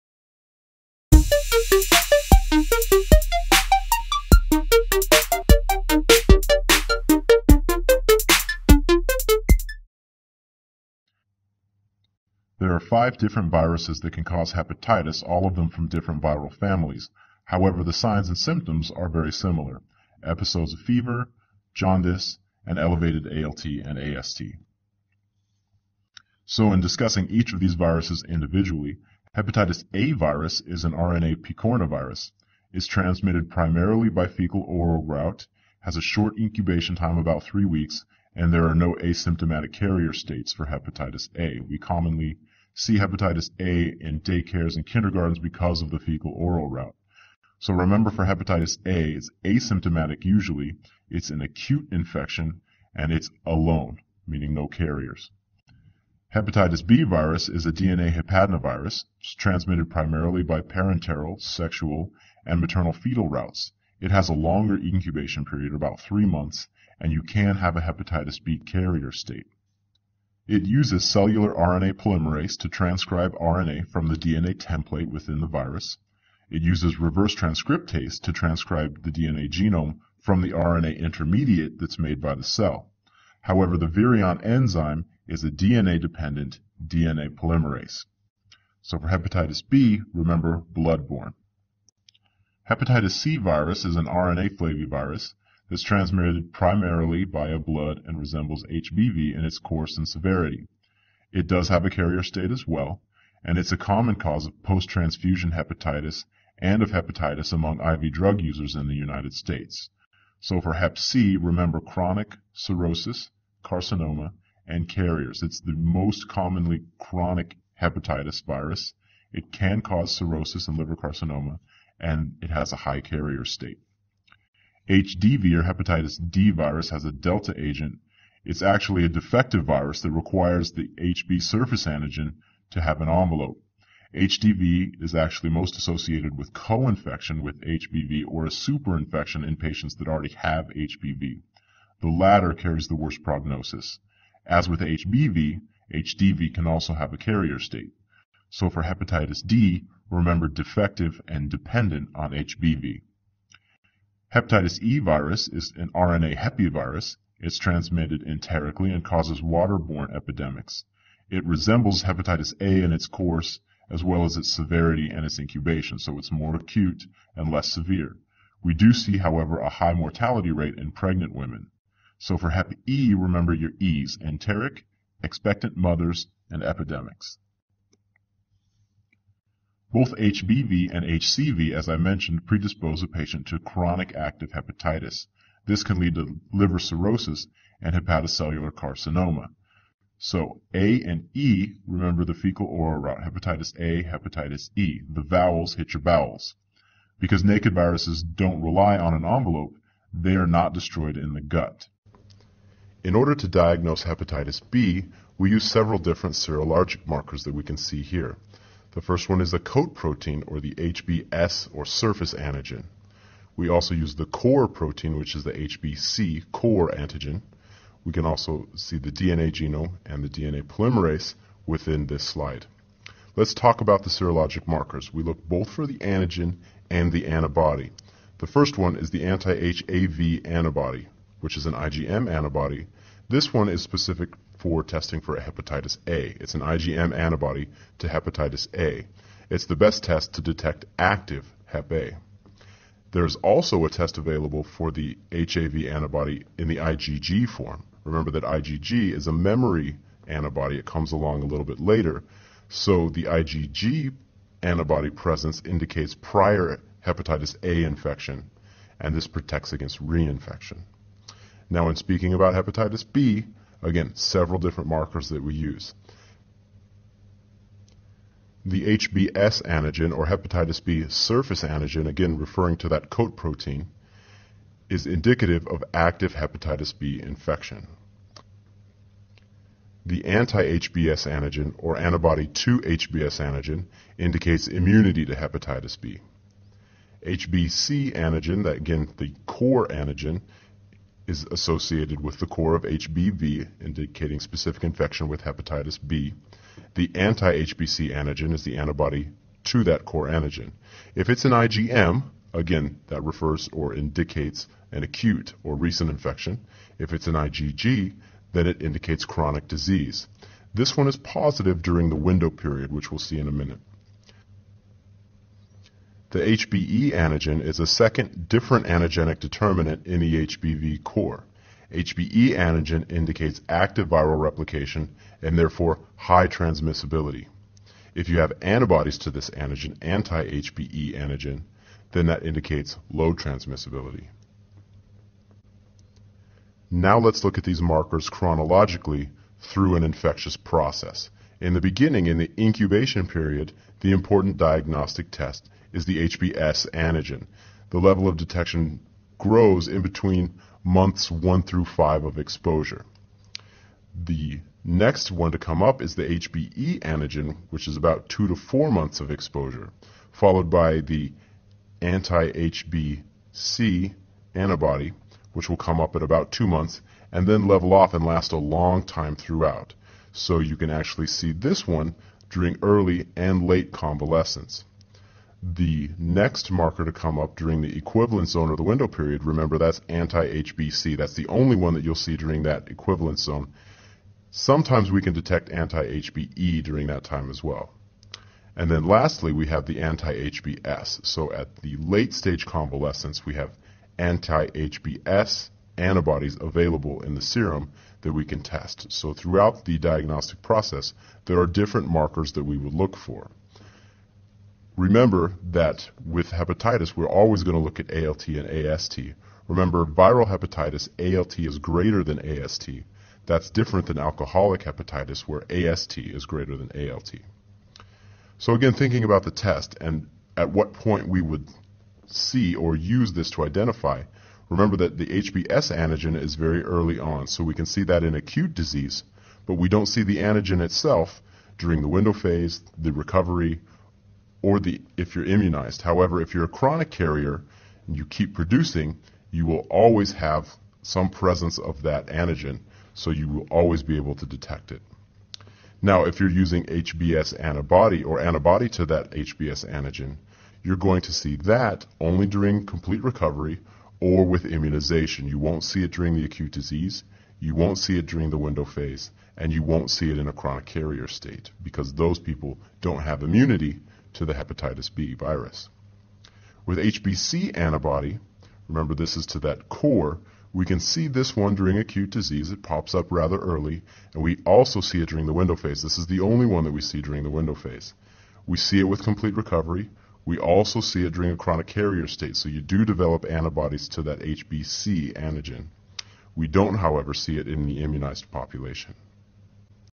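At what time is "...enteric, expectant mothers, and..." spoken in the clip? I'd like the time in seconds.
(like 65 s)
174 s.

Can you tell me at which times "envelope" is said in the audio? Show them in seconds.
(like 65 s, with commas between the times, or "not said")
133 s, 199 s.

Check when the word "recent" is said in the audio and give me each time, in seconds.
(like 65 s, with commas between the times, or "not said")
305 s.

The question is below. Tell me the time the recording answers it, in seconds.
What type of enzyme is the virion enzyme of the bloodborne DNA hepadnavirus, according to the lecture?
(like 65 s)
85 s.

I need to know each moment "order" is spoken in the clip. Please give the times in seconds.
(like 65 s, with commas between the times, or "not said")
203 s.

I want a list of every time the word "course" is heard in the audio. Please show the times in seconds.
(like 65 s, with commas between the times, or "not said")
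99 s, 163 s.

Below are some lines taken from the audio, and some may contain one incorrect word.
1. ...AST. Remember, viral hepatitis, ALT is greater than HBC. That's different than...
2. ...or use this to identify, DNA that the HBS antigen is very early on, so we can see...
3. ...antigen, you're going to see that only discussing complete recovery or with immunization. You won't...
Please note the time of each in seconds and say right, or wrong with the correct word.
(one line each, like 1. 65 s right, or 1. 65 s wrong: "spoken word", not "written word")
1. 408 s wrong: "AST", not "HBC"
2. 422 s wrong: "Remember", not "DNA"
3. 449 s wrong: "during", not "discussing".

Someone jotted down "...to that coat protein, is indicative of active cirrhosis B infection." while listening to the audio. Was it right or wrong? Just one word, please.
wrong.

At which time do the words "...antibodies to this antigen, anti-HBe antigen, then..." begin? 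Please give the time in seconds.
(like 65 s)
328 s.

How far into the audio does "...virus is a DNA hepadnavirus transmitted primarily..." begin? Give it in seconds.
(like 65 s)
57 s.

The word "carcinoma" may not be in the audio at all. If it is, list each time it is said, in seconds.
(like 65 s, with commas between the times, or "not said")
113 s, 120 s, 188 s.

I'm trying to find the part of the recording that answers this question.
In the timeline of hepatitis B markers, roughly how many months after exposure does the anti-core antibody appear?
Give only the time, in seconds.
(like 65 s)
366 s.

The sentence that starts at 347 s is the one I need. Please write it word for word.
The level of detection grows in between months 1 through 5 of exposure.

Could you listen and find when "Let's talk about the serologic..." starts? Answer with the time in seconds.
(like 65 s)
223 s.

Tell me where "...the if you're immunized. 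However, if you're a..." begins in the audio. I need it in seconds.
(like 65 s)
434 s.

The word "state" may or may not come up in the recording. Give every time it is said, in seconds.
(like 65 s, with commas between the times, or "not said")
40 s, 69 s, 102 s, 109 s, 123 s, 147 s, 461 s, 482 s.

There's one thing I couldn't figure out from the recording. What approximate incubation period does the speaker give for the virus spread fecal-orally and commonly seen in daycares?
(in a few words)
about three weeks.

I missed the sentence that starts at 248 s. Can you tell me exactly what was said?
Remember that IgG is a memory antibody.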